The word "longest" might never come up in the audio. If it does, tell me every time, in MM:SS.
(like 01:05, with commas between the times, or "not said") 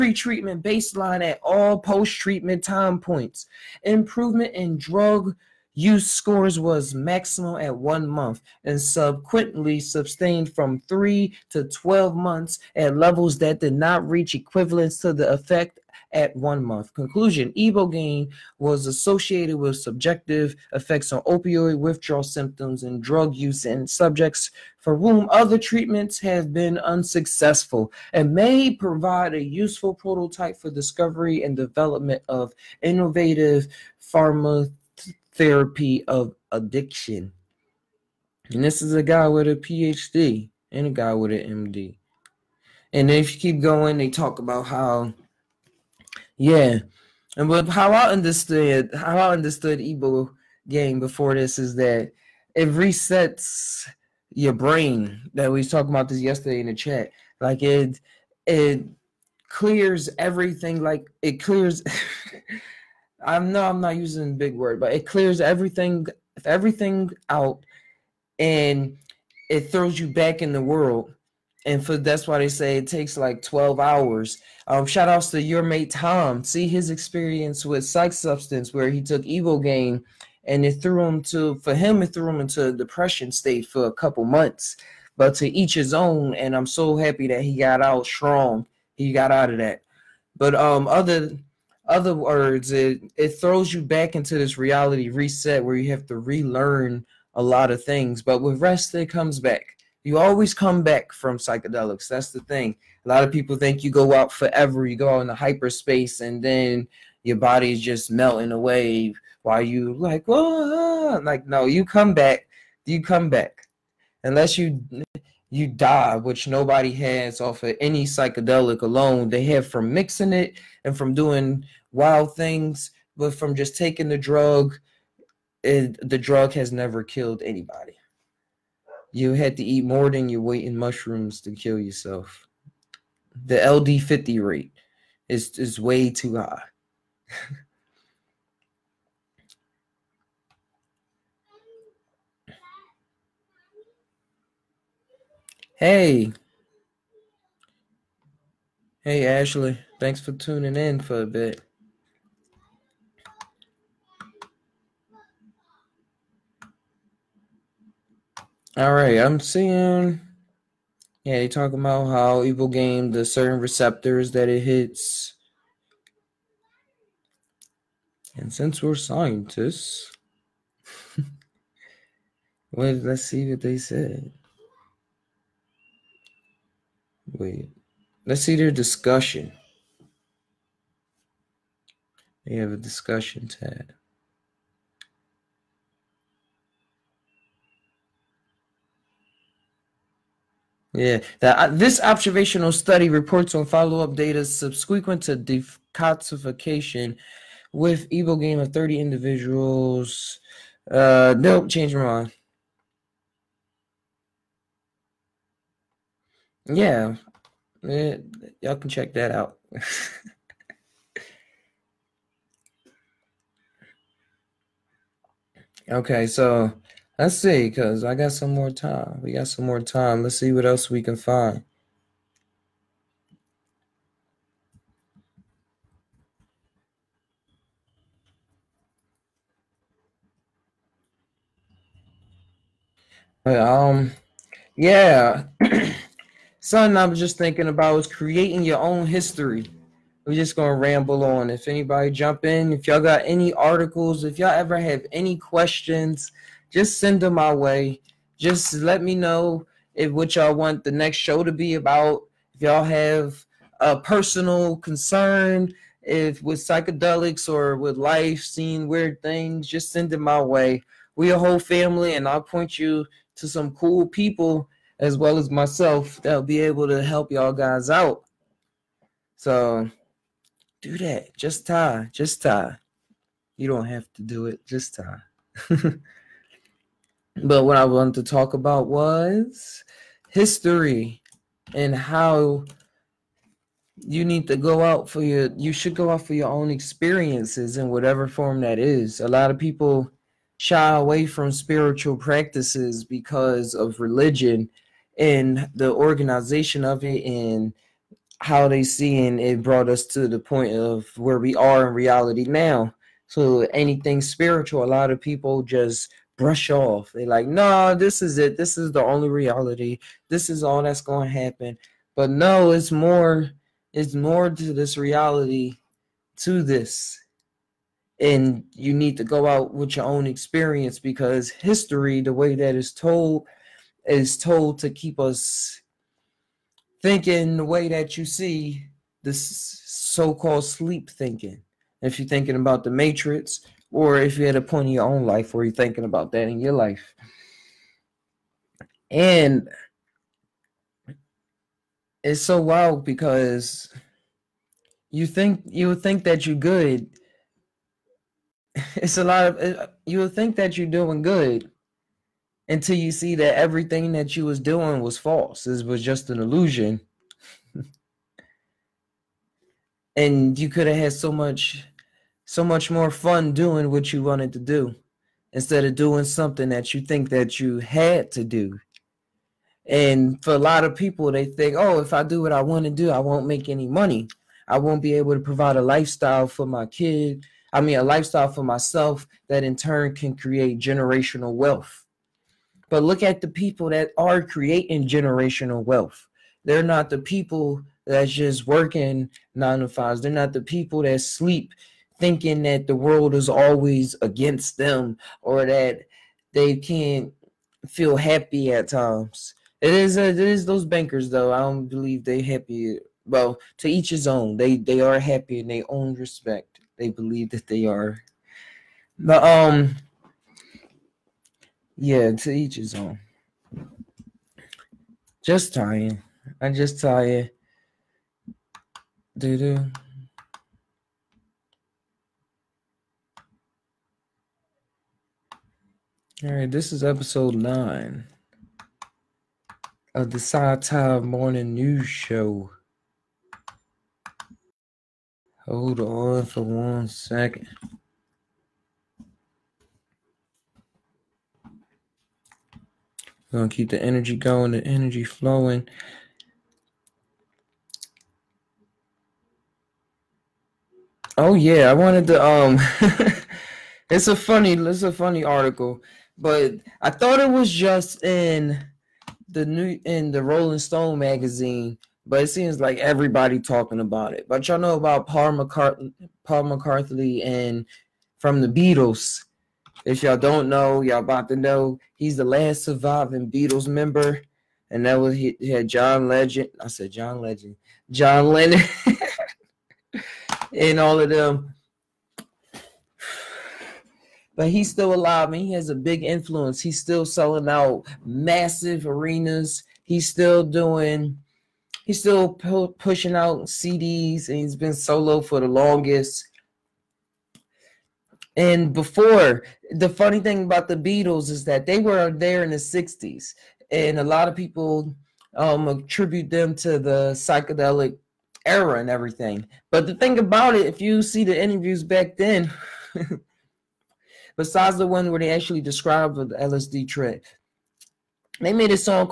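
08:15.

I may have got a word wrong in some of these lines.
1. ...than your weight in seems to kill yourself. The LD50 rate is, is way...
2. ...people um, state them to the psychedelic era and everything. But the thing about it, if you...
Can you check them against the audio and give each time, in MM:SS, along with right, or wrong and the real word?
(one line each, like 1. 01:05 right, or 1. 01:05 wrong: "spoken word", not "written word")
1. 02:10 wrong: "mushrooms", not "seems"
2. 08:24 wrong: "attribute", not "state".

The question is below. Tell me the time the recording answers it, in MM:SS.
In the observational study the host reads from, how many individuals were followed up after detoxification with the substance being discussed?
03:18.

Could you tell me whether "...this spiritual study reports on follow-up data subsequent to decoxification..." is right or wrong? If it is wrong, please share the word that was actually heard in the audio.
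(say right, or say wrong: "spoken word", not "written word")
wrong: "observational", not "spiritual".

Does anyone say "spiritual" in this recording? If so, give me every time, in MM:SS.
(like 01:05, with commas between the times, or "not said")
04:51, 05:04.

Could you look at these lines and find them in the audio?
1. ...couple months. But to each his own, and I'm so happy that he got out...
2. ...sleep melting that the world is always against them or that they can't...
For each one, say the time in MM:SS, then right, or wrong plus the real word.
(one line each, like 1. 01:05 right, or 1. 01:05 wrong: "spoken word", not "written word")
1. 01:23 right
2. 06:31 wrong: "thinking", not "melting".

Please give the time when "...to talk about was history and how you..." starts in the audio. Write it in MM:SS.
04:38.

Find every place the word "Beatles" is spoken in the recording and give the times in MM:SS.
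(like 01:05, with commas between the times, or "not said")
07:48, 07:53, 08:20.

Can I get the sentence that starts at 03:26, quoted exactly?
yeah, y'all can check that out.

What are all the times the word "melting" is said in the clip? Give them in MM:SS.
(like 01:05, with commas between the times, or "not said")
01:48.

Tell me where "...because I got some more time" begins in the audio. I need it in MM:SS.
03:37.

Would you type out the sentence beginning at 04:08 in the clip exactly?
Just let me know if what y'all want the next show to be about.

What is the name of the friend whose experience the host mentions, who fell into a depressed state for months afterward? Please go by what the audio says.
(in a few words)
Tom.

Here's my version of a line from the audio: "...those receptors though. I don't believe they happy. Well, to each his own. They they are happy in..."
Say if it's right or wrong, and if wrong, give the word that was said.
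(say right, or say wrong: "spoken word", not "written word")
wrong: "bankers", not "receptors".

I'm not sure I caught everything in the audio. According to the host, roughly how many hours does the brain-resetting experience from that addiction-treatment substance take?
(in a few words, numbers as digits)
12 hours.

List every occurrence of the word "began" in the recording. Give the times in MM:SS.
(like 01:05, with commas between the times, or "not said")
not said.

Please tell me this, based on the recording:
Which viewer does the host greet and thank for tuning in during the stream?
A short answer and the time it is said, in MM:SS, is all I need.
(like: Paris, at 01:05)
Ashley, at 02:29.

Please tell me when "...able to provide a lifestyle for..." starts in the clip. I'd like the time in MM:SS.
06:15.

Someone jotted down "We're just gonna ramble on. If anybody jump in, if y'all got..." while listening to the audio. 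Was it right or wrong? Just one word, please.
right.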